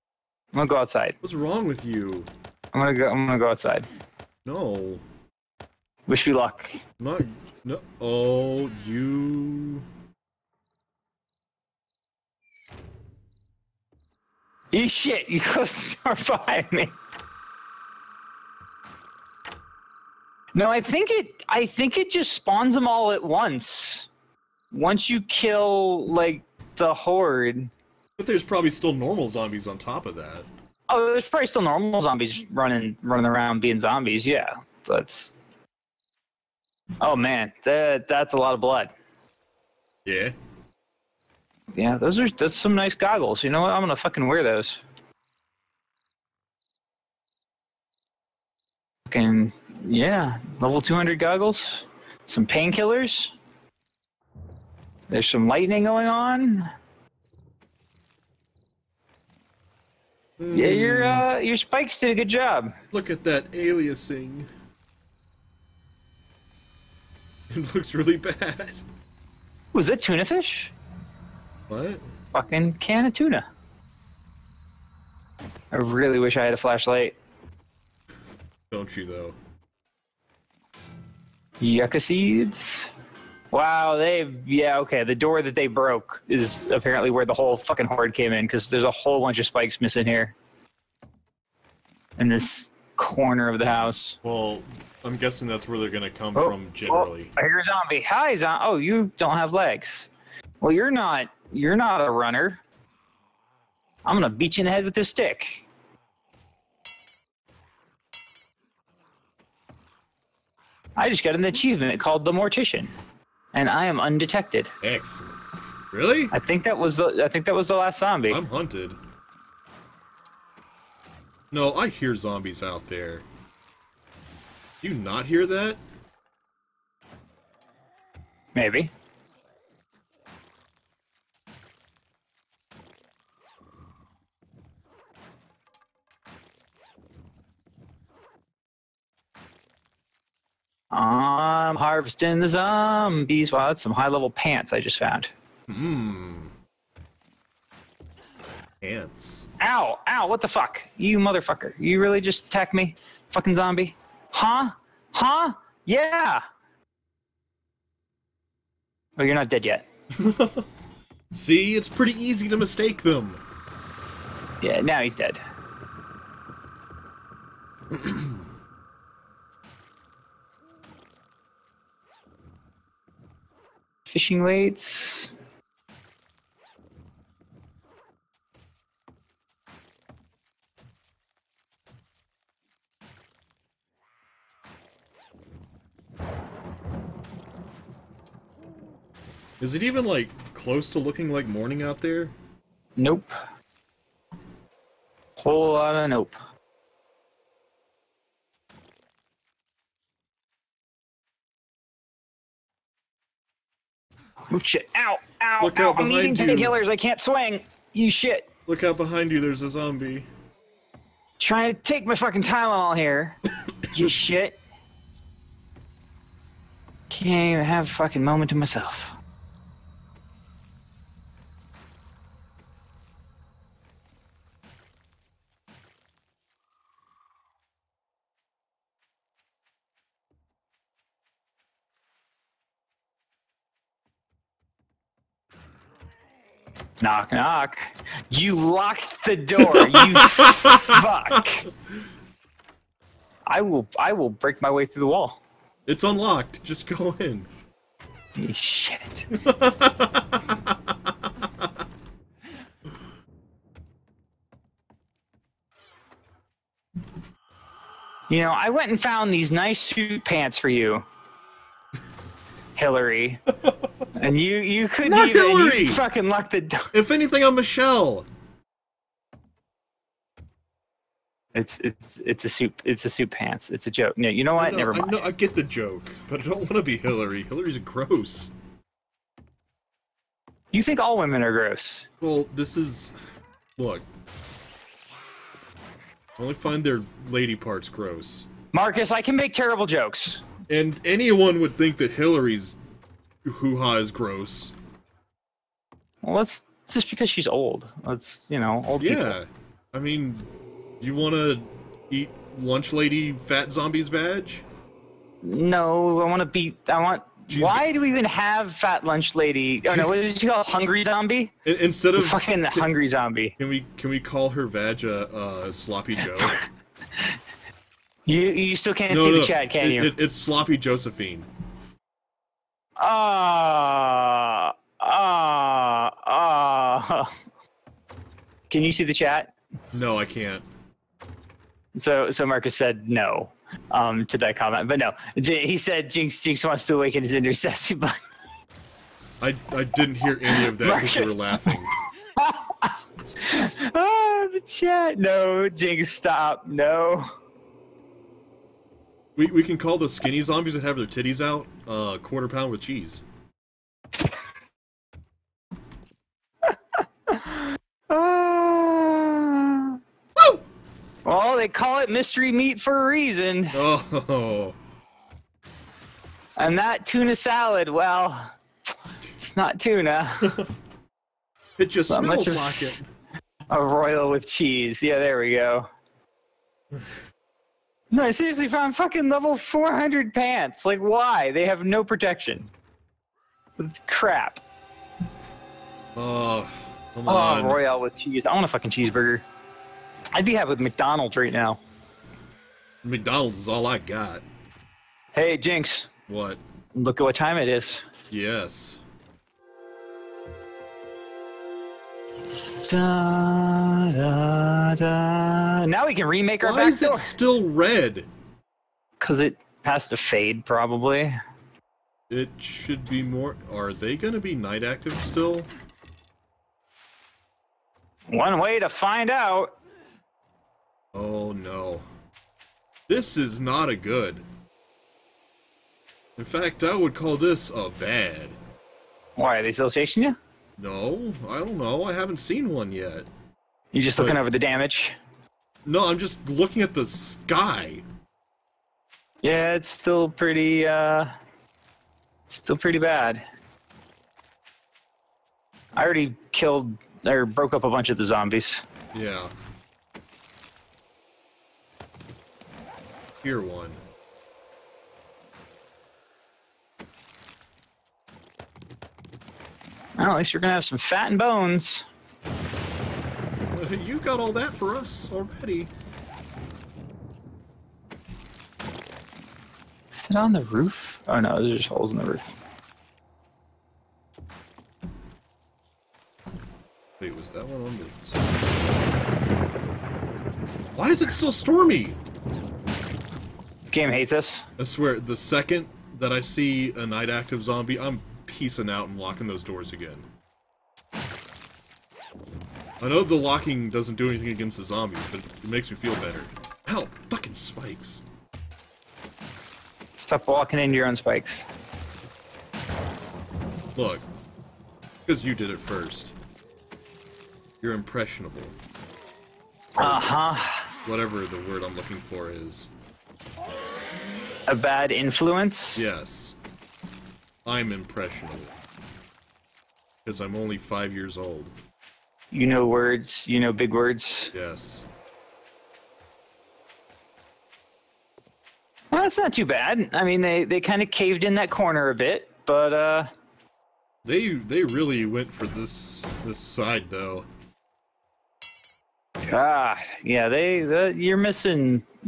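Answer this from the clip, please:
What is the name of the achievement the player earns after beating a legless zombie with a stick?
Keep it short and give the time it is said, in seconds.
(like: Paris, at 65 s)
The Mortician, at 112 s.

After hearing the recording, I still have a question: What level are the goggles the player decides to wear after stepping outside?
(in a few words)
200.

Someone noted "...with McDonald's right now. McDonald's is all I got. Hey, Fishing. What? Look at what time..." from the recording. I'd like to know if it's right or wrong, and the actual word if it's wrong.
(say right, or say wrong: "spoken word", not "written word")
wrong: "Jinx", not "Fishing".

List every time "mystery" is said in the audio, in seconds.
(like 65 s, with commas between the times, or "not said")
362 s.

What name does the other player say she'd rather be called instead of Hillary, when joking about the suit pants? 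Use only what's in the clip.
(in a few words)
Michelle.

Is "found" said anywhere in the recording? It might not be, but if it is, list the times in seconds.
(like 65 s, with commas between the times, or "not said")
144 s, 258 s, 378 s.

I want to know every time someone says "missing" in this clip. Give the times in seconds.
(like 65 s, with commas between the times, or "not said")
89 s, 541 s.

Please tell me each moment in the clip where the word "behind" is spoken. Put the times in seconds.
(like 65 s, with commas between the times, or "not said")
16 s, 208 s.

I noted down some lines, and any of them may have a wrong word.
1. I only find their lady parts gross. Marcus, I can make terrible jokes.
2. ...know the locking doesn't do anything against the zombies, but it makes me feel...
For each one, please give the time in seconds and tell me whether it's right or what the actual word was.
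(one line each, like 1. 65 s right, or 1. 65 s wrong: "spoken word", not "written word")
1. 286 s right
2. 493 s right.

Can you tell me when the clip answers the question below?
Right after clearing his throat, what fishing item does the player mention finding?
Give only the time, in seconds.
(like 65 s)
174 s.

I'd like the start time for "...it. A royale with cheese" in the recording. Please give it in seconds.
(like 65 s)
372 s.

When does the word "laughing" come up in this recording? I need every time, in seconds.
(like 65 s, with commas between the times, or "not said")
341 s.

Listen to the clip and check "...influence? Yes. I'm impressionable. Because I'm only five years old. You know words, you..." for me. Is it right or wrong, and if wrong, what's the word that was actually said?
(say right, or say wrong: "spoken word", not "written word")
right.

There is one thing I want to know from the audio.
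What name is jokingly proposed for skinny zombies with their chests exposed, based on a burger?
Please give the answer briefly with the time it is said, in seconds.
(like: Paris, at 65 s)
Quarter pound with cheese, at 352 s.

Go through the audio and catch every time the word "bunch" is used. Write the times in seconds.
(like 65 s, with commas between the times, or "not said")
89 s, 447 s.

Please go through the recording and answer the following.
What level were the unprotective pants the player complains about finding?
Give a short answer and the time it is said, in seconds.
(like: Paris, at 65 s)
400, at 379 s.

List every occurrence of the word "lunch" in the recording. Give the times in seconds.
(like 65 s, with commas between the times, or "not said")
302 s, 309 s.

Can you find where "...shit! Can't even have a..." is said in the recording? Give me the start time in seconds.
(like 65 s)
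214 s.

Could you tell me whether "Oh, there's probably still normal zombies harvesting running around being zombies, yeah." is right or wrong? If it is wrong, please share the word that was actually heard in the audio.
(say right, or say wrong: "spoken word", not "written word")
wrong: "running", not "harvesting".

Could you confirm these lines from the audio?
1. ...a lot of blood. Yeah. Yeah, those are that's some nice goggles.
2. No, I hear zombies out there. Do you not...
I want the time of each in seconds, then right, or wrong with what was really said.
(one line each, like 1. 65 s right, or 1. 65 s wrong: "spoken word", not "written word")
1. 38 s right
2. 121 s right.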